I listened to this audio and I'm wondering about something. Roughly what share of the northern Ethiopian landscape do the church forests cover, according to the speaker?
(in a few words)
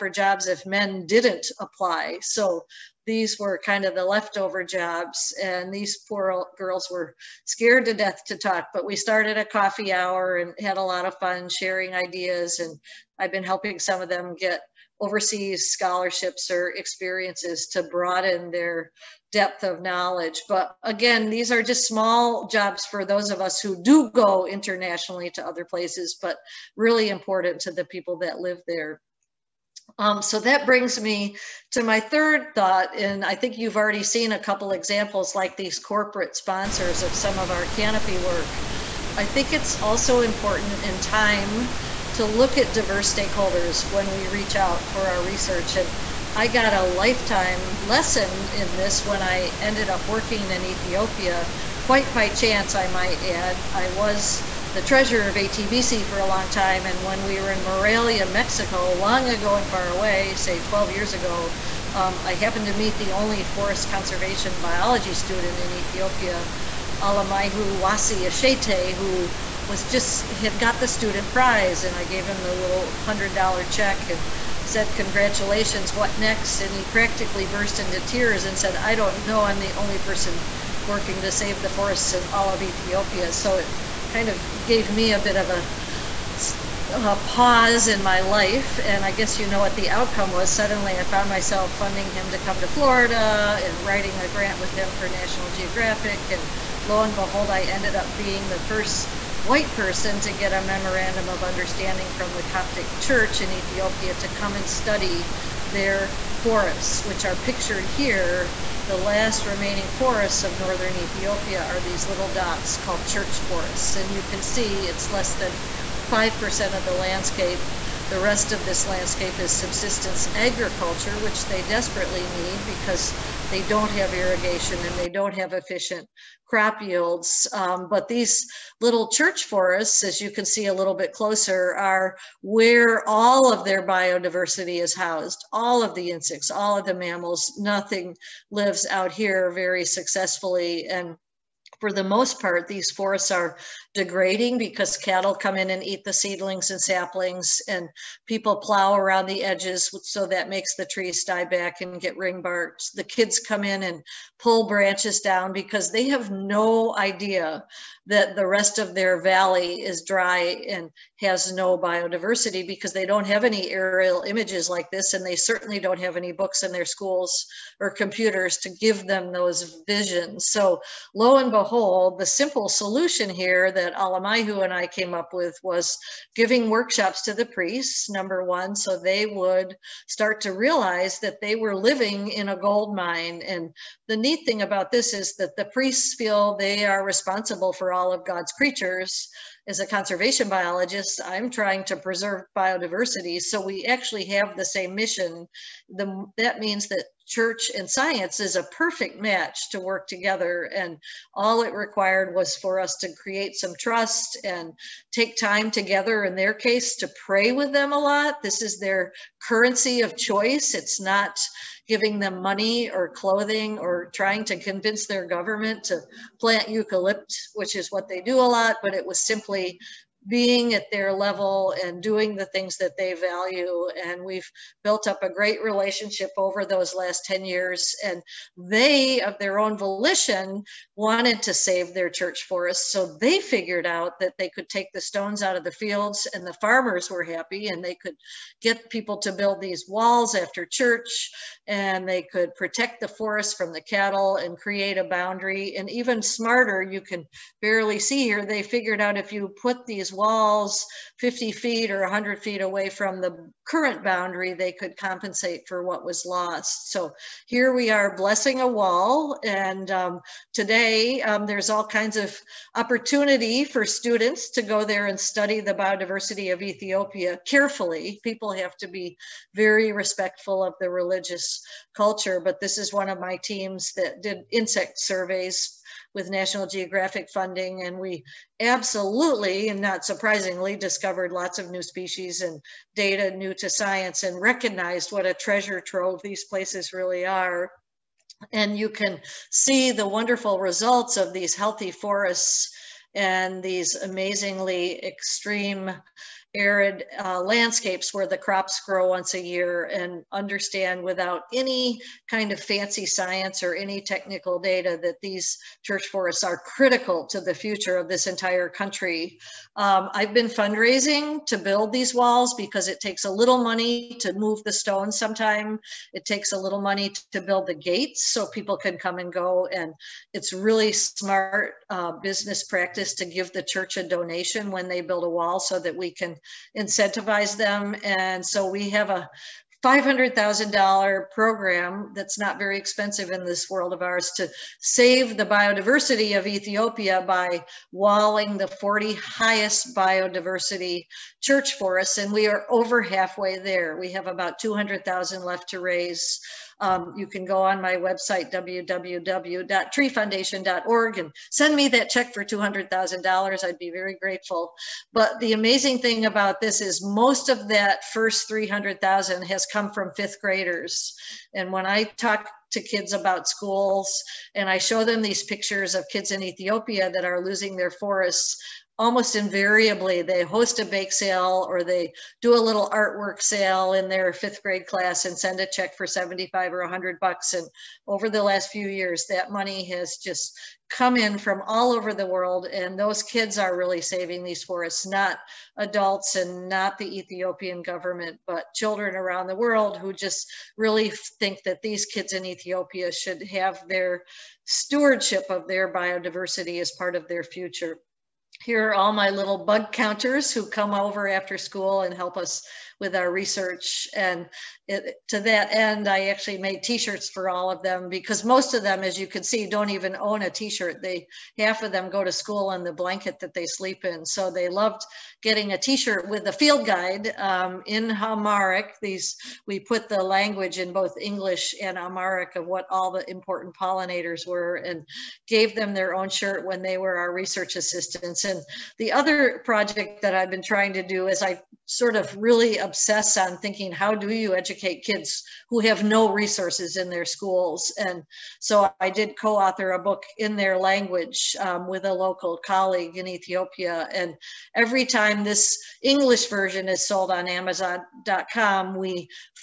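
less than 5%.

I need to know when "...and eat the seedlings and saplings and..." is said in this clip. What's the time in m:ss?
2:25.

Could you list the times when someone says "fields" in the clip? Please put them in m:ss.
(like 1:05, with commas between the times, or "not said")
3:55, 6:56.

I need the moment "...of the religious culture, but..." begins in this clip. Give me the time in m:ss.
4:30.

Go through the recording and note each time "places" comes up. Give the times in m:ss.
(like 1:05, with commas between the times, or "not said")
0:25, 4:46.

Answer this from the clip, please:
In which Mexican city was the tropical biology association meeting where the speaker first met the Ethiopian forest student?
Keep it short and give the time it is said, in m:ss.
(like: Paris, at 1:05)
Morelia, at 0:57.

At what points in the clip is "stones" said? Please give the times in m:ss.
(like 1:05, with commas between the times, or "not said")
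3:55, 5:14.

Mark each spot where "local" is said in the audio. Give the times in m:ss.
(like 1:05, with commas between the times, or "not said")
7:22.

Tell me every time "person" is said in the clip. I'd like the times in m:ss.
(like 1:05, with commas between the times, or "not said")
1:19, 1:39.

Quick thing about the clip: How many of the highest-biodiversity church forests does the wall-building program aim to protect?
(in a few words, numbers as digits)
40.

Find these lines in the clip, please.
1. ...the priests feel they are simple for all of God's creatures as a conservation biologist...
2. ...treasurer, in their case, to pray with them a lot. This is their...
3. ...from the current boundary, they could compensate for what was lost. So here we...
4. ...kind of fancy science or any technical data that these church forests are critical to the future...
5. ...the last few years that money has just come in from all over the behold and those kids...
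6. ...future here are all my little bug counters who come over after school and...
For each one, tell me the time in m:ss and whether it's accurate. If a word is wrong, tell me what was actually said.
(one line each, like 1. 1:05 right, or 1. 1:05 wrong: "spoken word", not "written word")
1. 3:05 wrong: "responsible", not "simple"
2. 3:25 wrong: "together", not "treasurer"
3. 4:12 right
4. 5:02 right
5. 6:18 wrong: "world", not "behold"
6. 6:37 right.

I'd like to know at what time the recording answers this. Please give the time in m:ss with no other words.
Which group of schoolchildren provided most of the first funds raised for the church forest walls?
6:00.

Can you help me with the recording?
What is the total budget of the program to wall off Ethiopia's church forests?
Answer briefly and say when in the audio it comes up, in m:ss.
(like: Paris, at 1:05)
$500,000, at 5:29.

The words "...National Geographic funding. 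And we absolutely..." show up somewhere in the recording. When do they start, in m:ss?
4:36.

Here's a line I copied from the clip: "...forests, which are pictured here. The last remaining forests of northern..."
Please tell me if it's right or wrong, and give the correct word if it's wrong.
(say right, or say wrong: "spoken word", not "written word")
right.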